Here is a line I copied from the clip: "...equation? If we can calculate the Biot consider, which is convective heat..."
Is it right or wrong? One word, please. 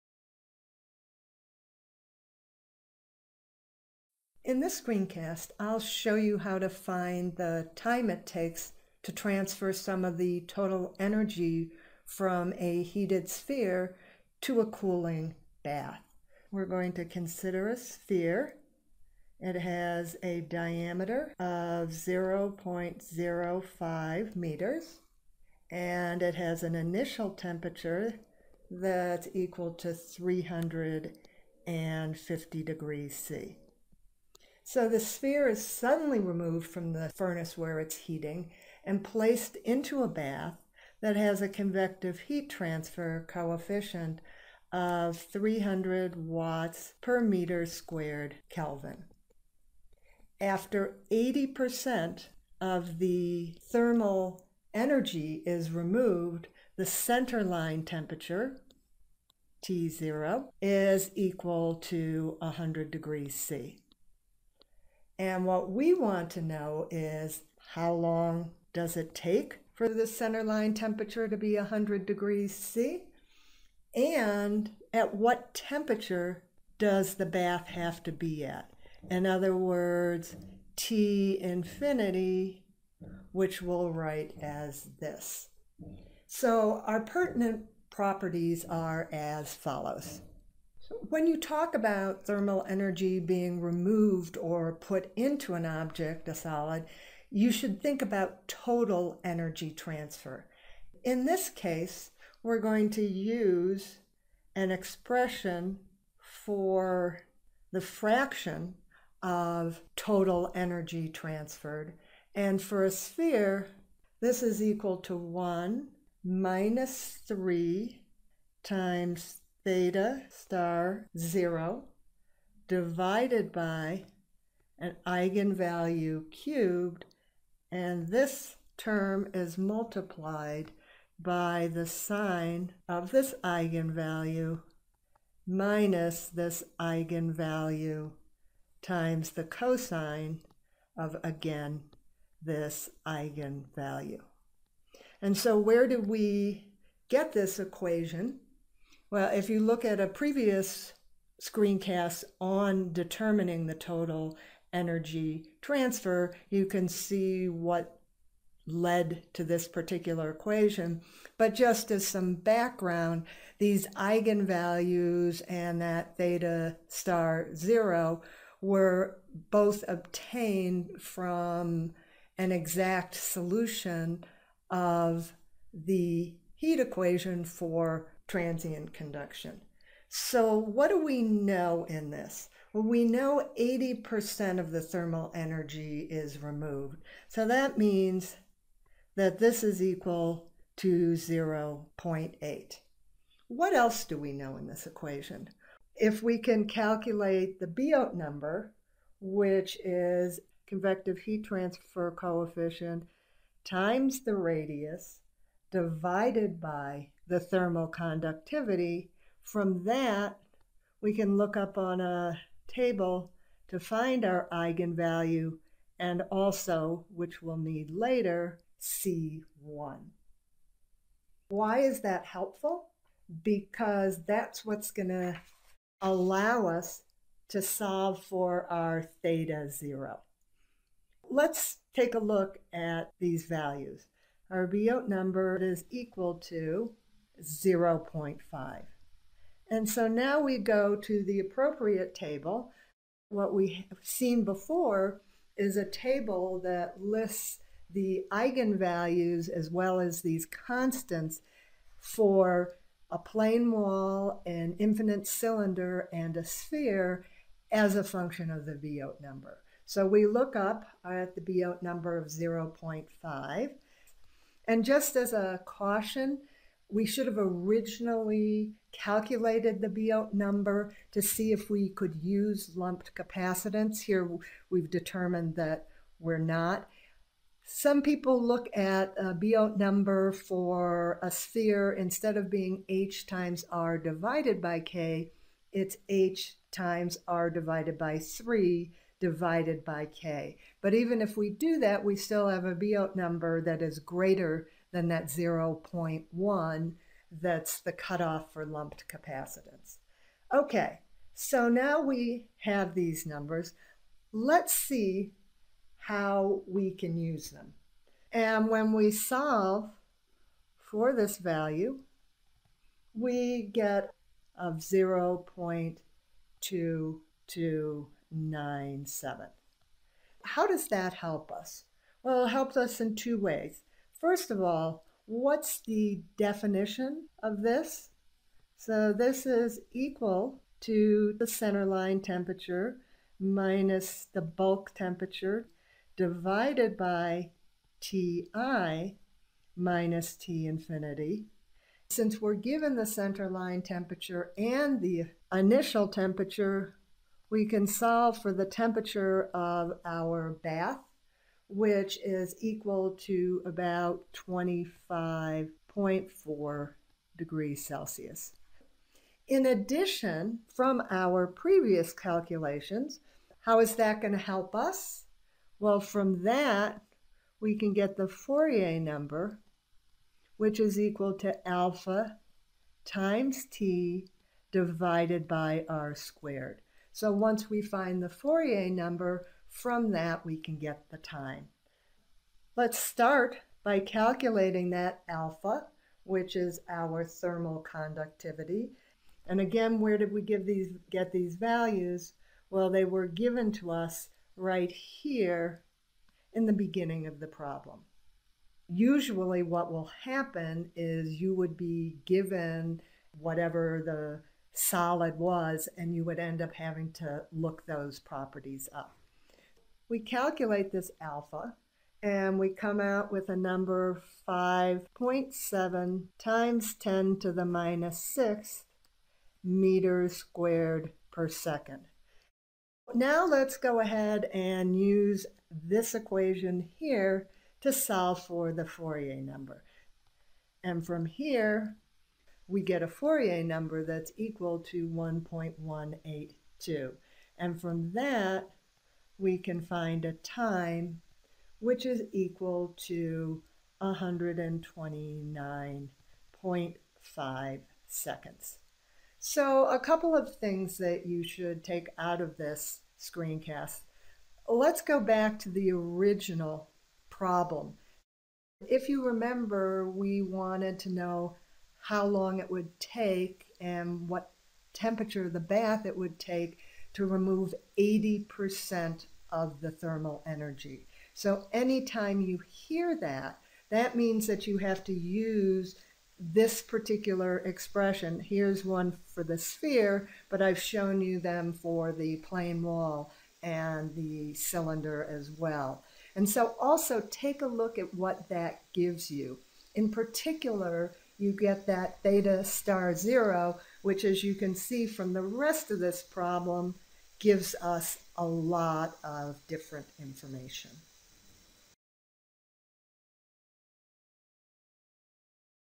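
wrong.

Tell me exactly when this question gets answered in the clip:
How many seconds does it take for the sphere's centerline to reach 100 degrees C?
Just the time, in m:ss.
7:24.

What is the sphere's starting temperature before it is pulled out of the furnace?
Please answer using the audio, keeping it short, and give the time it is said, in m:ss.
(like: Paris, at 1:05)
350 degrees C, at 0:29.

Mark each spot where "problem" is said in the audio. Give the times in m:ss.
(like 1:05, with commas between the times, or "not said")
6:37, 7:37, 8:16.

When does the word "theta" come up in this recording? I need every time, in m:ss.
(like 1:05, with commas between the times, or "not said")
1:59, 2:46, 3:49, 8:12.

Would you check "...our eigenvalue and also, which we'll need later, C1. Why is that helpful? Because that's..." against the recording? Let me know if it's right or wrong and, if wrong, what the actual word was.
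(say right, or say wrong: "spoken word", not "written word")
right.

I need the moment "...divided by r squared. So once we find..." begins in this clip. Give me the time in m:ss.
6:14.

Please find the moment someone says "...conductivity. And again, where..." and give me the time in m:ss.
6:27.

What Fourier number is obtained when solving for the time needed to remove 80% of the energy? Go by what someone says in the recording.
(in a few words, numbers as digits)
1.182.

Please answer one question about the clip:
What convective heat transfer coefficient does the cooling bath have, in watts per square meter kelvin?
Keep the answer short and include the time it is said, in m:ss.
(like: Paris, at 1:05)
300, at 0:45.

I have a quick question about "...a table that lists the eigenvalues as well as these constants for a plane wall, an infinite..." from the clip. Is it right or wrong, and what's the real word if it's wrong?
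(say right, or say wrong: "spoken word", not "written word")
right.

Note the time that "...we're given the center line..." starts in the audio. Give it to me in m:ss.
5:42.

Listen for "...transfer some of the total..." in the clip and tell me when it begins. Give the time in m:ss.
0:09.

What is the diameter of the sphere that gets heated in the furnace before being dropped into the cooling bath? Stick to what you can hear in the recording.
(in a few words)
0.05 meters.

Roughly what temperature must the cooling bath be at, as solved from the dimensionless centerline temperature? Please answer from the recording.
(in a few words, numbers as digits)
25.4 degrees Celsius.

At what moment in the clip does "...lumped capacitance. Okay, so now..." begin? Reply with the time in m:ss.
4:58.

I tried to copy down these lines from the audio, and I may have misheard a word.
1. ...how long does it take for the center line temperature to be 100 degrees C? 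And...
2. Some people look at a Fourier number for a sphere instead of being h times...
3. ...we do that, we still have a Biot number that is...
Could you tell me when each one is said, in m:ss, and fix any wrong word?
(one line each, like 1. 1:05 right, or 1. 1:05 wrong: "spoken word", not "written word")
1. 1:07 right
2. 4:37 wrong: "Biot", not "Fourier"
3. 4:51 right.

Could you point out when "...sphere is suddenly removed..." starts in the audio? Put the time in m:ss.
0:35.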